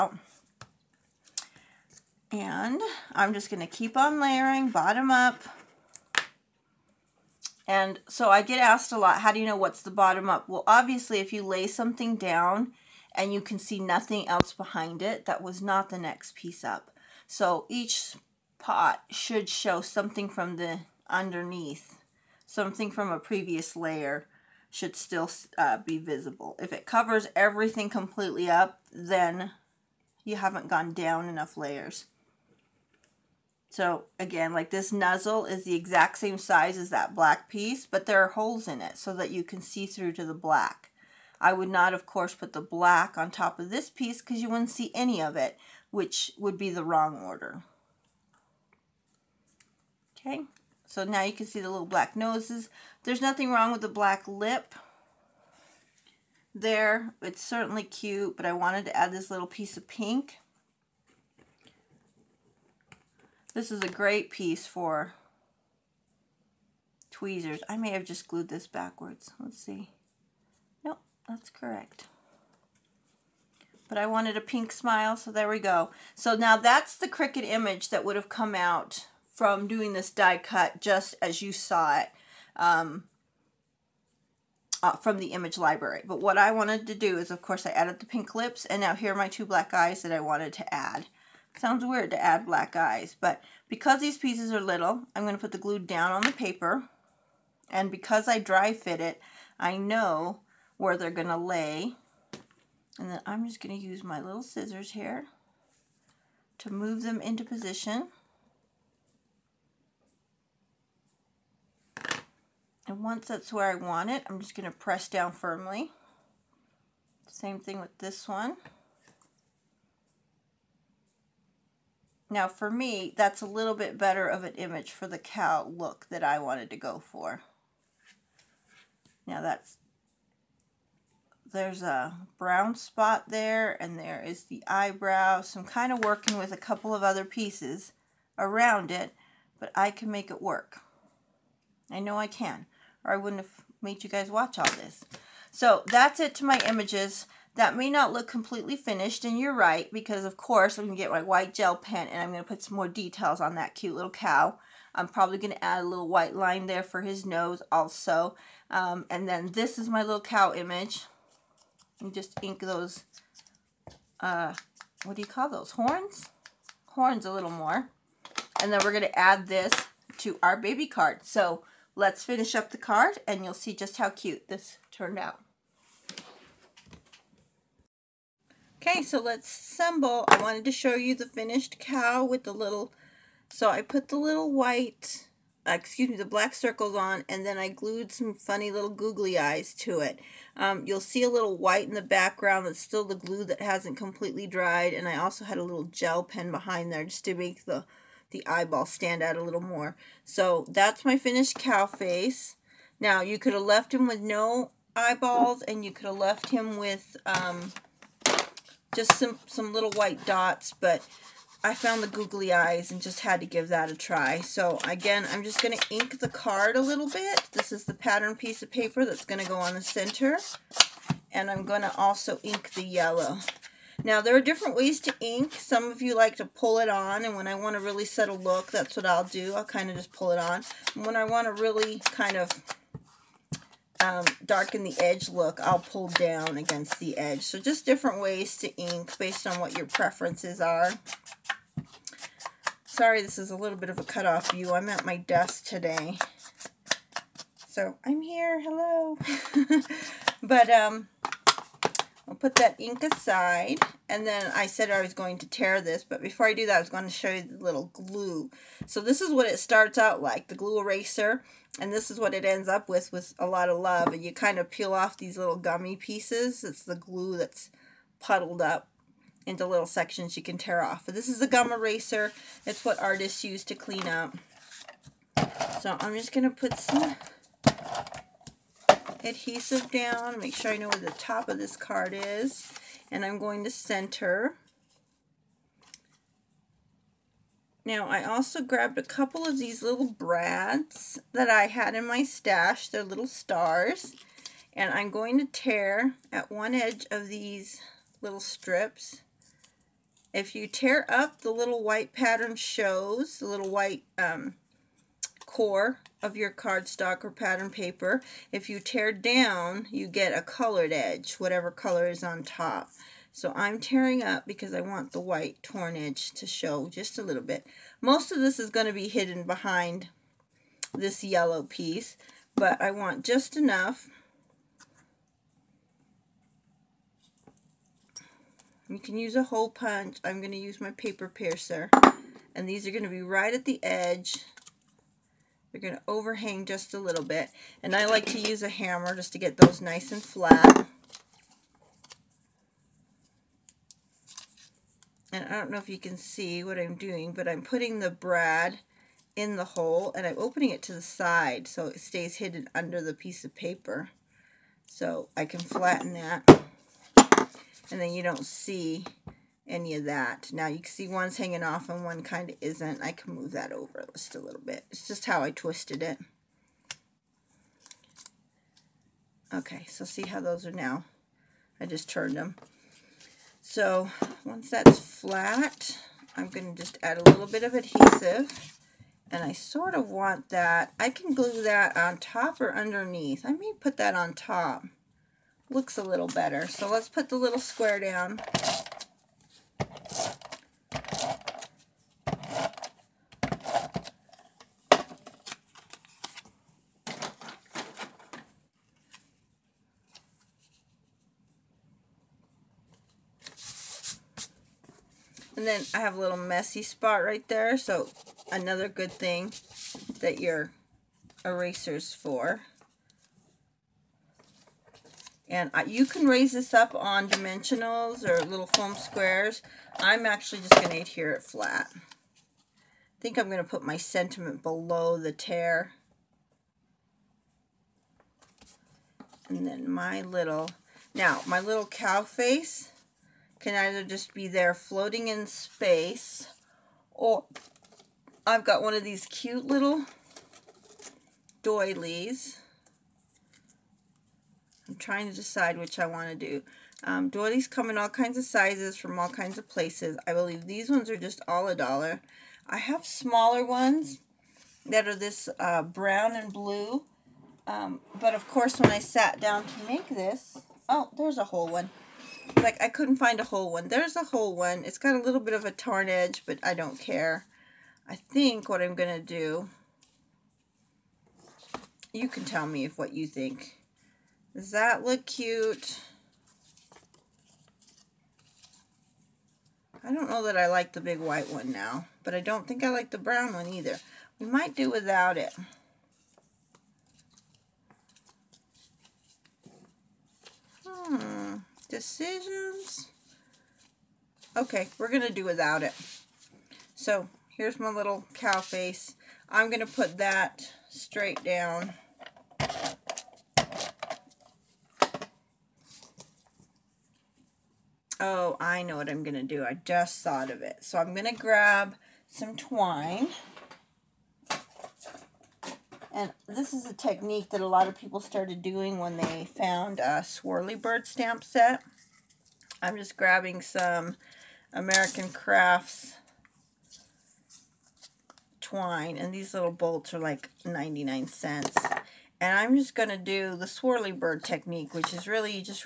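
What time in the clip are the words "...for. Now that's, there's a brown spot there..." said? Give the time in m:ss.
2:06.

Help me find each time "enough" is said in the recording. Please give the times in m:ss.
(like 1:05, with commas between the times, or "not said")
0:31, 5:23.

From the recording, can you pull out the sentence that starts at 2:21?
I know I can or I wouldn't have made you guys watch all this.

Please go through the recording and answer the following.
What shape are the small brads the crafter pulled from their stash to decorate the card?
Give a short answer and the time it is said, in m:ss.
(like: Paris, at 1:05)
Stars, at 4:53.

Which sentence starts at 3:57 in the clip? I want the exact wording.
So just different ways to ink based on what your preferences are.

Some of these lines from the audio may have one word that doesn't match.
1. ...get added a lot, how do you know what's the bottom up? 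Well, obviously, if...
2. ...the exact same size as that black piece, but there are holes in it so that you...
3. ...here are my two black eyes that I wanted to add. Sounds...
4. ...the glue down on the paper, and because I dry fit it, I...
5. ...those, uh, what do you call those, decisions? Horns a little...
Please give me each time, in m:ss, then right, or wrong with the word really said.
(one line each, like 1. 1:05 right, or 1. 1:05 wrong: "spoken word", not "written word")
1. 0:08 wrong: "asked", not "added"
2. 0:35 right
3. 1:28 right
4. 1:35 right
5. 2:42 wrong: "horns", not "decisions".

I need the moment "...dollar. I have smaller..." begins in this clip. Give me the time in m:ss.
7:31.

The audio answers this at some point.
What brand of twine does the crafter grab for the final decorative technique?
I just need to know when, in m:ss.
8:44.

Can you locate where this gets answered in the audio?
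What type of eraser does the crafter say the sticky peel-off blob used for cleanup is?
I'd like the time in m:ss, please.
4:31.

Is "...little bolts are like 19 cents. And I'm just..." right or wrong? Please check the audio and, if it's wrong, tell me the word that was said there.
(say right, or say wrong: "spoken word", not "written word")
wrong: "99", not "19".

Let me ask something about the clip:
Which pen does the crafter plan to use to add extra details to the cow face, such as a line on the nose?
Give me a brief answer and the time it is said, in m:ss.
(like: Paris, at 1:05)
White gel pen, at 2:31.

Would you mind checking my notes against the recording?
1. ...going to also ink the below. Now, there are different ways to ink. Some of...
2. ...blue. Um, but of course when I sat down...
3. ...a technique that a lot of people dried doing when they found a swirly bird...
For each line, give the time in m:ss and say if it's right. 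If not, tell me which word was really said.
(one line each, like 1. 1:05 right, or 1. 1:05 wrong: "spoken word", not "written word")
1. 3:41 wrong: "yellow", not "below"
2. 7:36 right
3. 8:36 wrong: "started", not "dried".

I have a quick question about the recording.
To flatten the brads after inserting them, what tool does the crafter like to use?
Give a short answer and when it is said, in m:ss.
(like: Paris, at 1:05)
Hammer, at 5:38.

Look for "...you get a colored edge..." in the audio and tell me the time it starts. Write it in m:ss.
5:09.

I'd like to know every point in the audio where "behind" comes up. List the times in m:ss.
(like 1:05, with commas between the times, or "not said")
0:14, 3:16, 5:19.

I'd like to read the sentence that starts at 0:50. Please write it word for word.
Okay, so now you can see the little black noses.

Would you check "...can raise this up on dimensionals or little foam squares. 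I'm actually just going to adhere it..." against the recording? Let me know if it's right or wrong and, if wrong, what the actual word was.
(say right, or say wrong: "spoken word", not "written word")
right.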